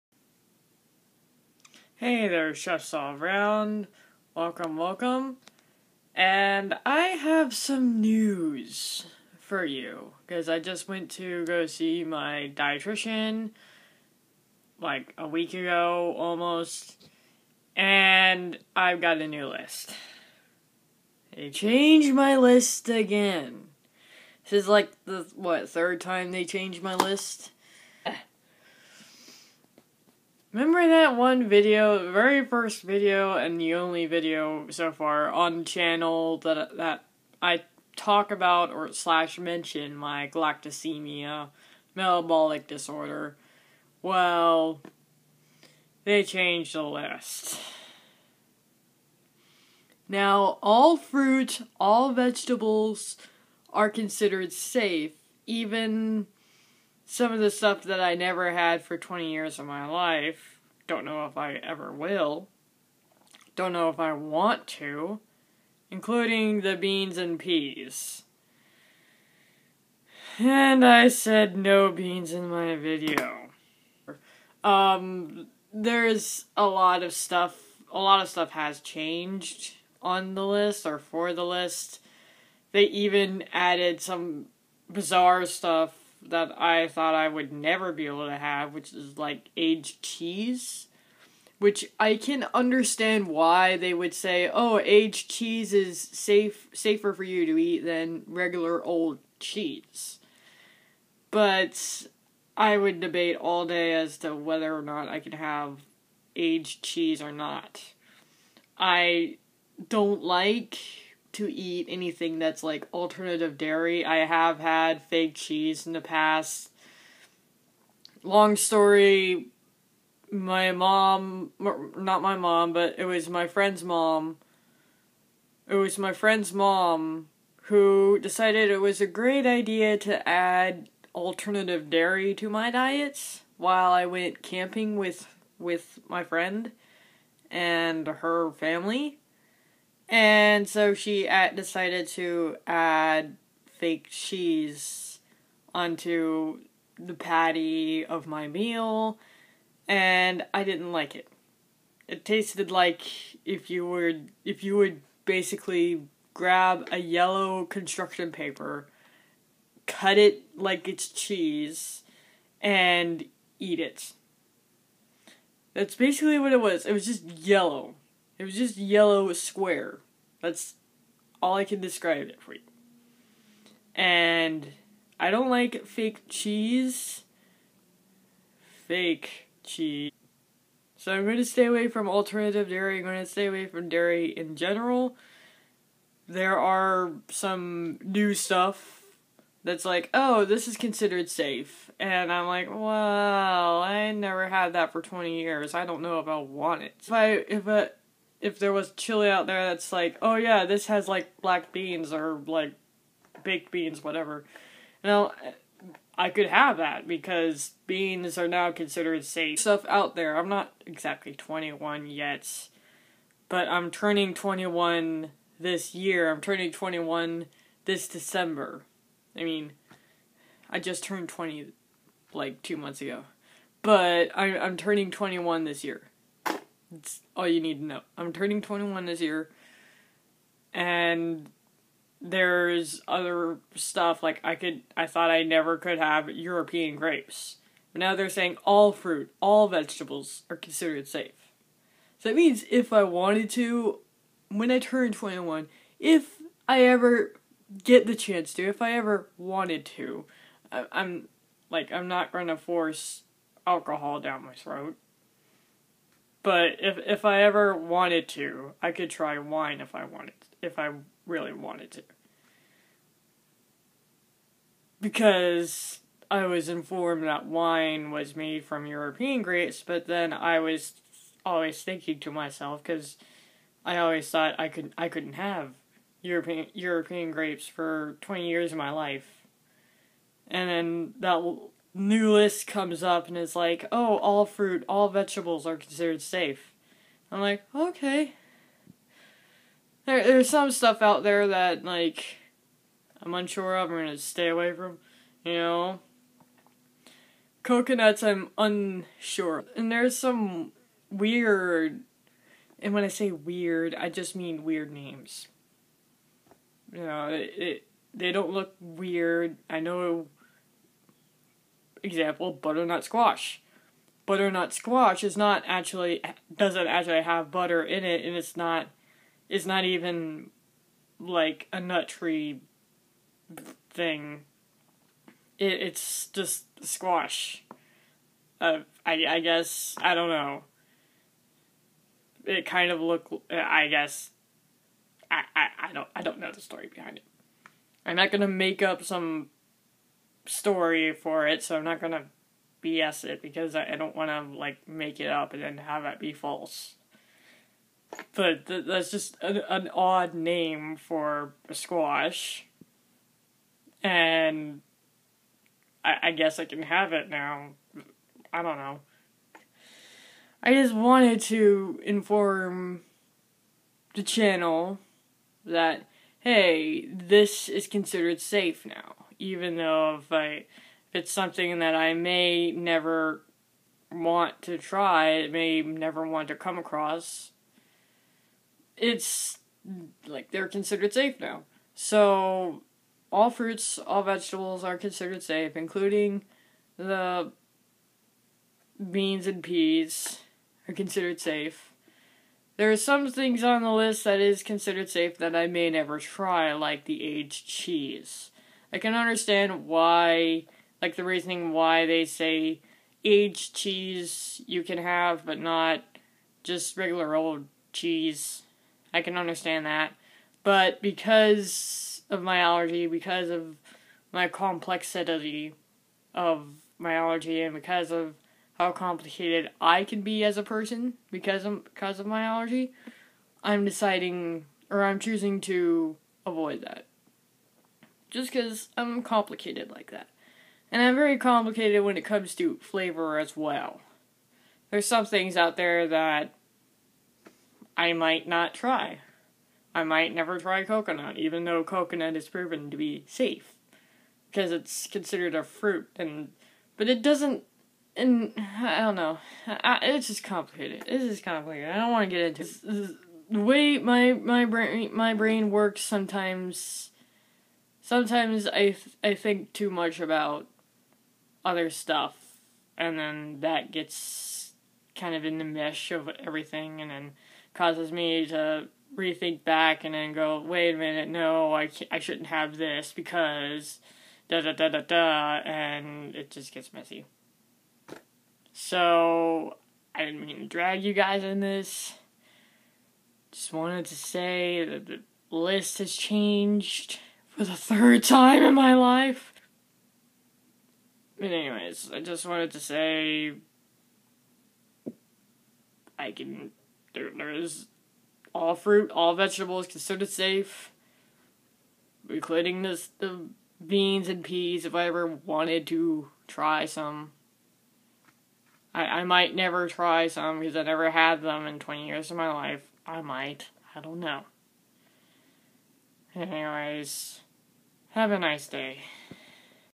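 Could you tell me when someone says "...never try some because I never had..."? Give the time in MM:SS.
08:29.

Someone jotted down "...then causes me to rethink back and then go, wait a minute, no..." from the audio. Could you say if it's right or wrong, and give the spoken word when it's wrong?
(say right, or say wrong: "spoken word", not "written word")
right.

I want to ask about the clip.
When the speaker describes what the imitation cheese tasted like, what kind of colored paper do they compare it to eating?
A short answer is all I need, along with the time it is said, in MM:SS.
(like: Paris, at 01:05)
yellow construction paper, at 02:36.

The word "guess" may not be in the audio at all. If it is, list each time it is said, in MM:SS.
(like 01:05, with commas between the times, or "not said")
05:29, 05:33, 05:56.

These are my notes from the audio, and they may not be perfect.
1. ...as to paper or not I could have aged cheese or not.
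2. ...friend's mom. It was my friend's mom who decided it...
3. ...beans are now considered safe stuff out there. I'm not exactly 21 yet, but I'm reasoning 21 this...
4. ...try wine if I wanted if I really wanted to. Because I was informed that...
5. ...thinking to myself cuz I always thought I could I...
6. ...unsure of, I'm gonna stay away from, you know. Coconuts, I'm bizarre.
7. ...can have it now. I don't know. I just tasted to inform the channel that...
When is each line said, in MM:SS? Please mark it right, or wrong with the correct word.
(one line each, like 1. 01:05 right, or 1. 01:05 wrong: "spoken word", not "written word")
1. 01:43 wrong: "whether", not "paper"
2. 02:03 right
3. 03:27 wrong: "turning", not "reasoning"
4. 04:19 right
5. 04:31 right
6. 04:53 wrong: "unsure", not "bizarre"
7. 05:56 wrong: "wanted", not "tasted".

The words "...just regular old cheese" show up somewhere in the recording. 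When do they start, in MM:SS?
06:46.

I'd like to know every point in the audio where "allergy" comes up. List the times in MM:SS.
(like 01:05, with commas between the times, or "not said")
06:52, 06:57, 07:02.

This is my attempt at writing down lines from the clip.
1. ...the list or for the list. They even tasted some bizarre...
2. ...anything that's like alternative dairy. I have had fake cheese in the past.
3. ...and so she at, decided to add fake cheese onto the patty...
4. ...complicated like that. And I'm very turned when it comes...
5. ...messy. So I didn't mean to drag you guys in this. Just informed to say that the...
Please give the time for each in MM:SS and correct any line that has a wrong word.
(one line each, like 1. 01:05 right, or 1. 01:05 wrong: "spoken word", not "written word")
1. 01:20 wrong: "added", not "tasted"
2. 01:51 right
3. 02:20 right
4. 07:09 wrong: "complicated", not "turned"
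5. 07:56 wrong: "wanted", not "informed".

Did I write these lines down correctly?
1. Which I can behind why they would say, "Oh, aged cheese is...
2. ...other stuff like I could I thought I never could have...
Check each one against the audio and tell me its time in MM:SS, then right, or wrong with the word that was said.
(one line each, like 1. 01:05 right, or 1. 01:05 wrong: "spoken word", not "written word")
1. 01:31 wrong: "understand", not "behind"
2. 03:53 right.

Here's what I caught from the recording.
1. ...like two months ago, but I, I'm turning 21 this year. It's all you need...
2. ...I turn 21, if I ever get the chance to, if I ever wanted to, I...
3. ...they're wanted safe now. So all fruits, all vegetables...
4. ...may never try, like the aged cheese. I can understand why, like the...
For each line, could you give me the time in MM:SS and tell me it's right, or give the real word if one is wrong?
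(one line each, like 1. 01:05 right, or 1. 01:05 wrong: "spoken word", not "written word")
1. 03:42 right
2. 04:04 right
3. 06:20 wrong: "considered", not "wanted"
4. 06:35 right.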